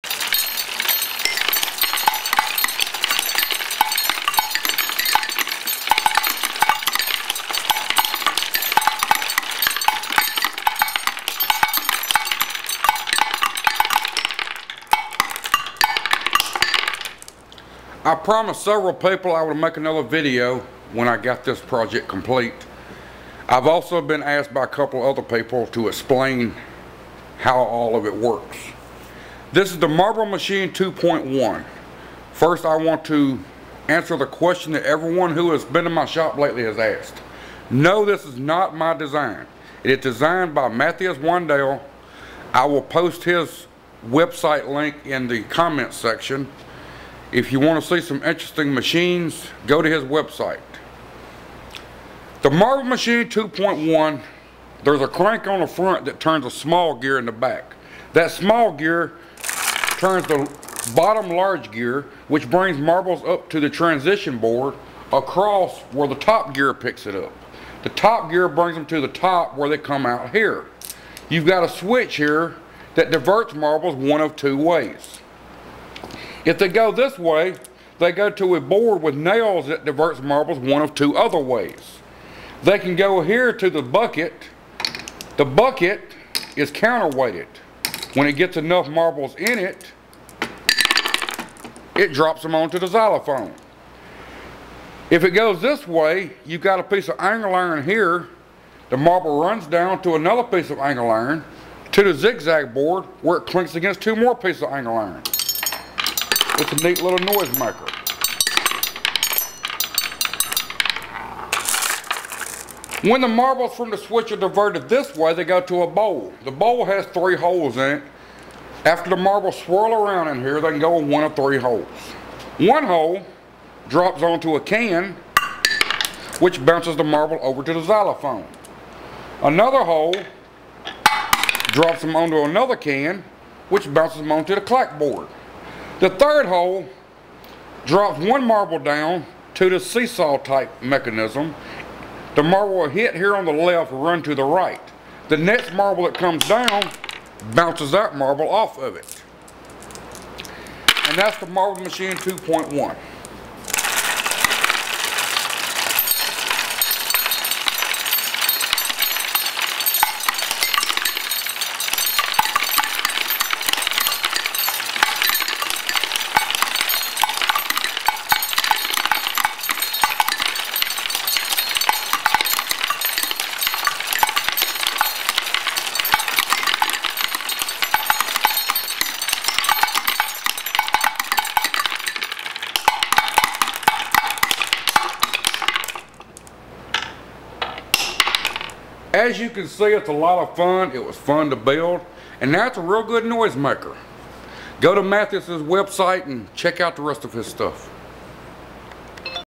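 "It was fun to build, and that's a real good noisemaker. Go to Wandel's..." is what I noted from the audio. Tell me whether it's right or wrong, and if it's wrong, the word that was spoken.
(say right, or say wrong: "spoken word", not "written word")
wrong: "Mathis", not "Wandel".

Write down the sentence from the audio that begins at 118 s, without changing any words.
After the marbles swirl around in here, they can go in one of three holes.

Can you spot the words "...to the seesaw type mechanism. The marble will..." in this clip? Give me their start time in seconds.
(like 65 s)
139 s.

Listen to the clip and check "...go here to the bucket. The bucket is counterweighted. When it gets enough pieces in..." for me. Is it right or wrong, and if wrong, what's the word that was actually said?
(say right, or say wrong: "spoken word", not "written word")
wrong: "marbles", not "pieces".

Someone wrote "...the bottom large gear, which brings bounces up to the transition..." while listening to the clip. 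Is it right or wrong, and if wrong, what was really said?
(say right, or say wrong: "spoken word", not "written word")
wrong: "marbles", not "bounces".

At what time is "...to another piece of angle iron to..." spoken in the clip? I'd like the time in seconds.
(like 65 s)
100 s.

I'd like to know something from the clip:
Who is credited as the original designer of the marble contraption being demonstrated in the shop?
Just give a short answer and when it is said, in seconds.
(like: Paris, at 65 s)
Matthias Wandel, at 40 s.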